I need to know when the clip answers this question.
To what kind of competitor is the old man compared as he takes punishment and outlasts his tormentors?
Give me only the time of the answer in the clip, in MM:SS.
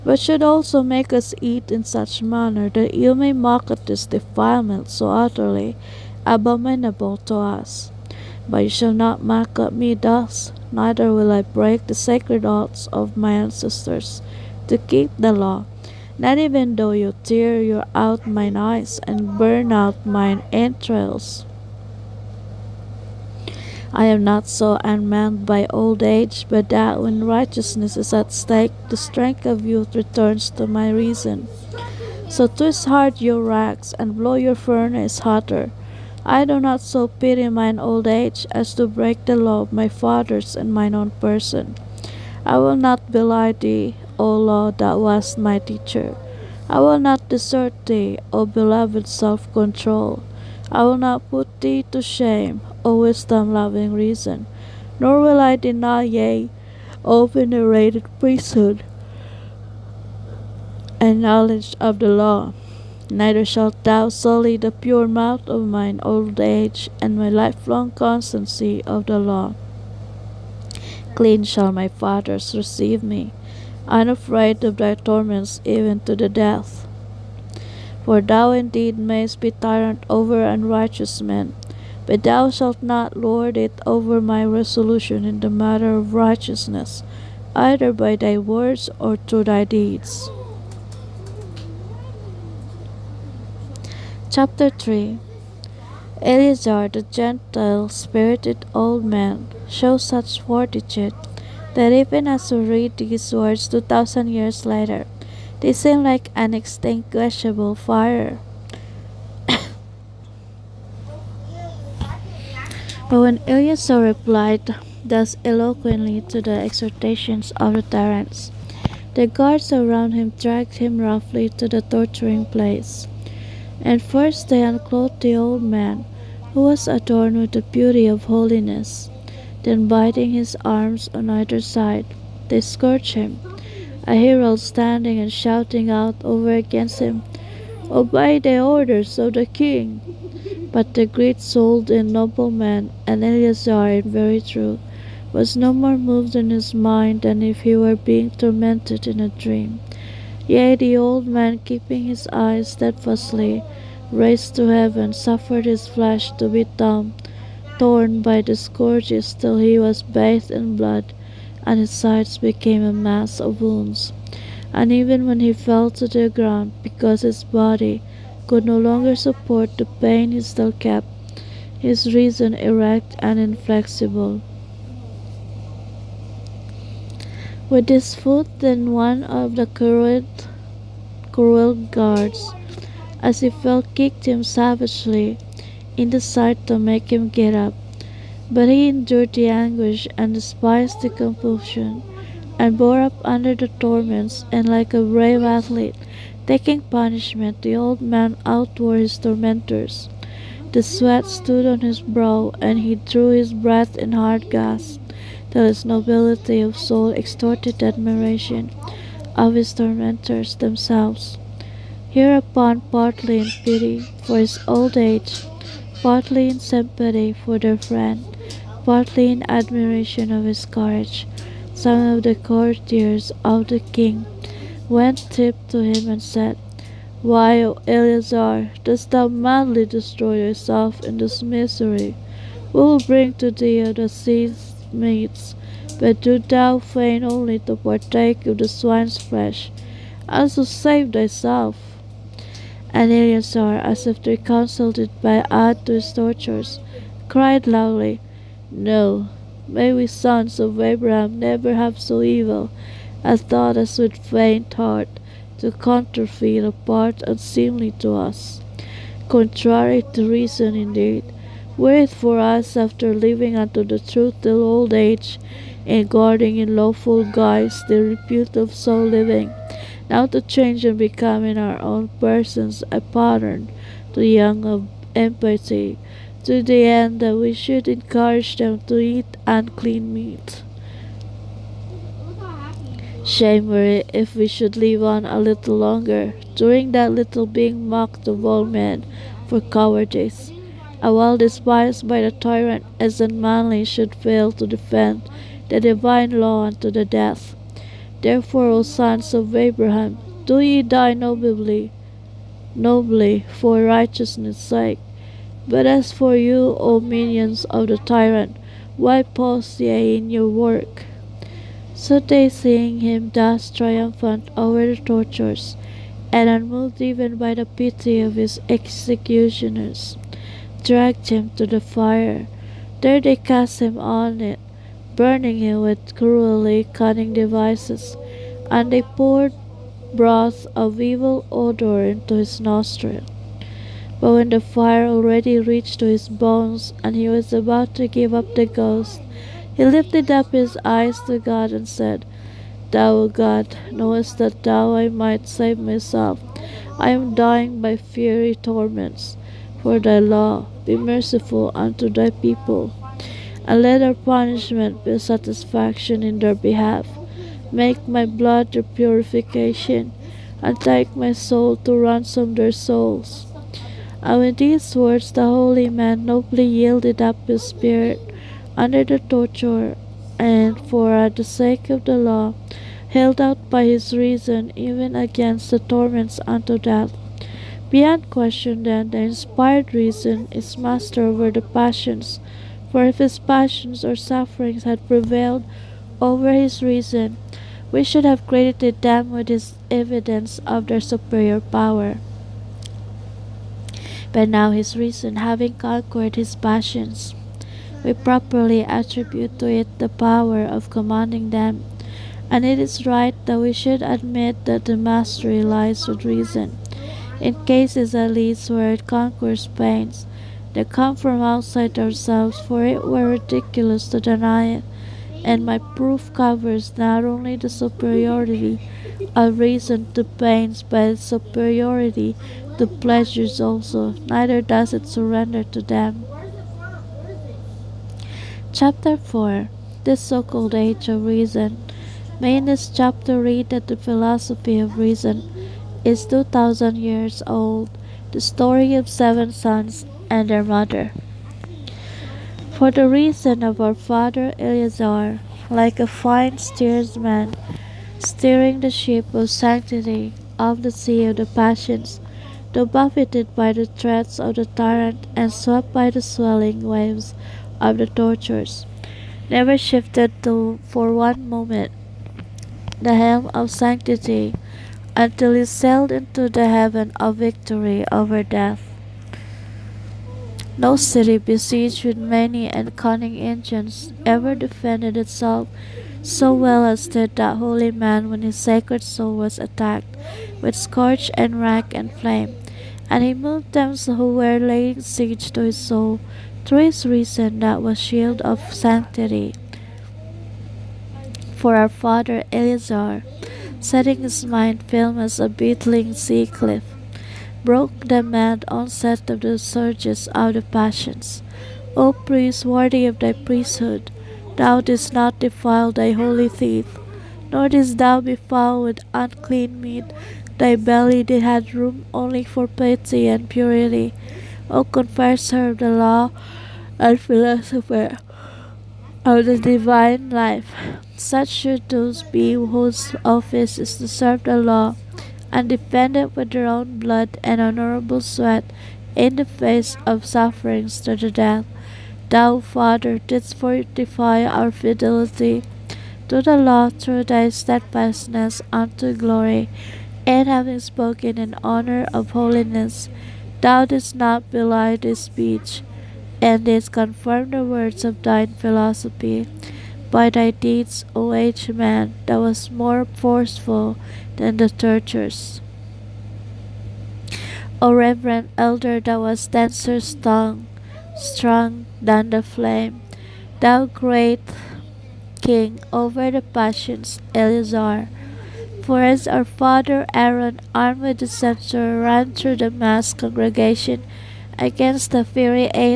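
03:15.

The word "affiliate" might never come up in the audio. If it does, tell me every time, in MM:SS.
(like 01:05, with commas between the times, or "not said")
not said.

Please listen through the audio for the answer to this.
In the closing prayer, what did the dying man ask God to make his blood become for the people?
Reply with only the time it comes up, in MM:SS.
05:58.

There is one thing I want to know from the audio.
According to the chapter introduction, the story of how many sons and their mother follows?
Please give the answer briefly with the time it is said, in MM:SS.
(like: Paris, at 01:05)
7, at 07:19.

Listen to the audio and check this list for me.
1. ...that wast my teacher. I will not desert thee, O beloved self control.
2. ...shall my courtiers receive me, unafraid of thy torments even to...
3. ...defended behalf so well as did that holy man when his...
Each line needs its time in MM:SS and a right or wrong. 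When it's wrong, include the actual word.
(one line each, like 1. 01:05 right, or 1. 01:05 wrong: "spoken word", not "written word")
1. 00:44 right
2. 01:11 wrong: "fathers", not "courtiers"
3. 07:54 wrong: "itself", not "behalf".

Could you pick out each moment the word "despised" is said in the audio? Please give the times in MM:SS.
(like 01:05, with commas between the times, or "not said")
03:10, 04:51.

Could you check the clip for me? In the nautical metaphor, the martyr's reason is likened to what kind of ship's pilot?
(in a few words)
a fine steersman.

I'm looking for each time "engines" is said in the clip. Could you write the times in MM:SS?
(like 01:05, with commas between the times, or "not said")
07:53.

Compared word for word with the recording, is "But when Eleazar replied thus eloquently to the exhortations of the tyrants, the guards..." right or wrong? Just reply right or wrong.
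right.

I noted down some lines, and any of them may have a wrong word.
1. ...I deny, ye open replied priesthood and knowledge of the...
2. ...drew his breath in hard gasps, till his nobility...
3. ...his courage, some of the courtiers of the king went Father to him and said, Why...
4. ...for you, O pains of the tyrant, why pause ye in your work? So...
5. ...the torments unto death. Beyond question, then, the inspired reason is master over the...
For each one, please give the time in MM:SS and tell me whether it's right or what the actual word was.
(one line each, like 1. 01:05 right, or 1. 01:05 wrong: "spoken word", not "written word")
1. 00:55 wrong: "venerated", not "replied"
2. 03:22 right
3. 03:40 wrong: "Tip", not "Father"
4. 05:06 wrong: "minions", not "pains"
5. 06:15 right.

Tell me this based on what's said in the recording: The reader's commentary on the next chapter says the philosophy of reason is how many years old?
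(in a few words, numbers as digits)
2000.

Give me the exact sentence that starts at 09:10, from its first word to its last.
By thy deeds, O aged man, thou was more forceful than the tortures.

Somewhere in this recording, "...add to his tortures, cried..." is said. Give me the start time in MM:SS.
04:05.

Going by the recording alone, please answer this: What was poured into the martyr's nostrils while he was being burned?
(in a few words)
broth of evil odor.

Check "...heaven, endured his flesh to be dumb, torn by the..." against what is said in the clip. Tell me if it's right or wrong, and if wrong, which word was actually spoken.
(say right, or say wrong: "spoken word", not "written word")
wrong: "suffered", not "endured".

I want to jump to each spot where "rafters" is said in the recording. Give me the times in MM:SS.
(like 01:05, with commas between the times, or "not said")
not said.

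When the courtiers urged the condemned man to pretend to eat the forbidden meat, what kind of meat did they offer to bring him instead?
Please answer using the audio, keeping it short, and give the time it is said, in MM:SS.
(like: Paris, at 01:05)
the sea's meats, at 03:53.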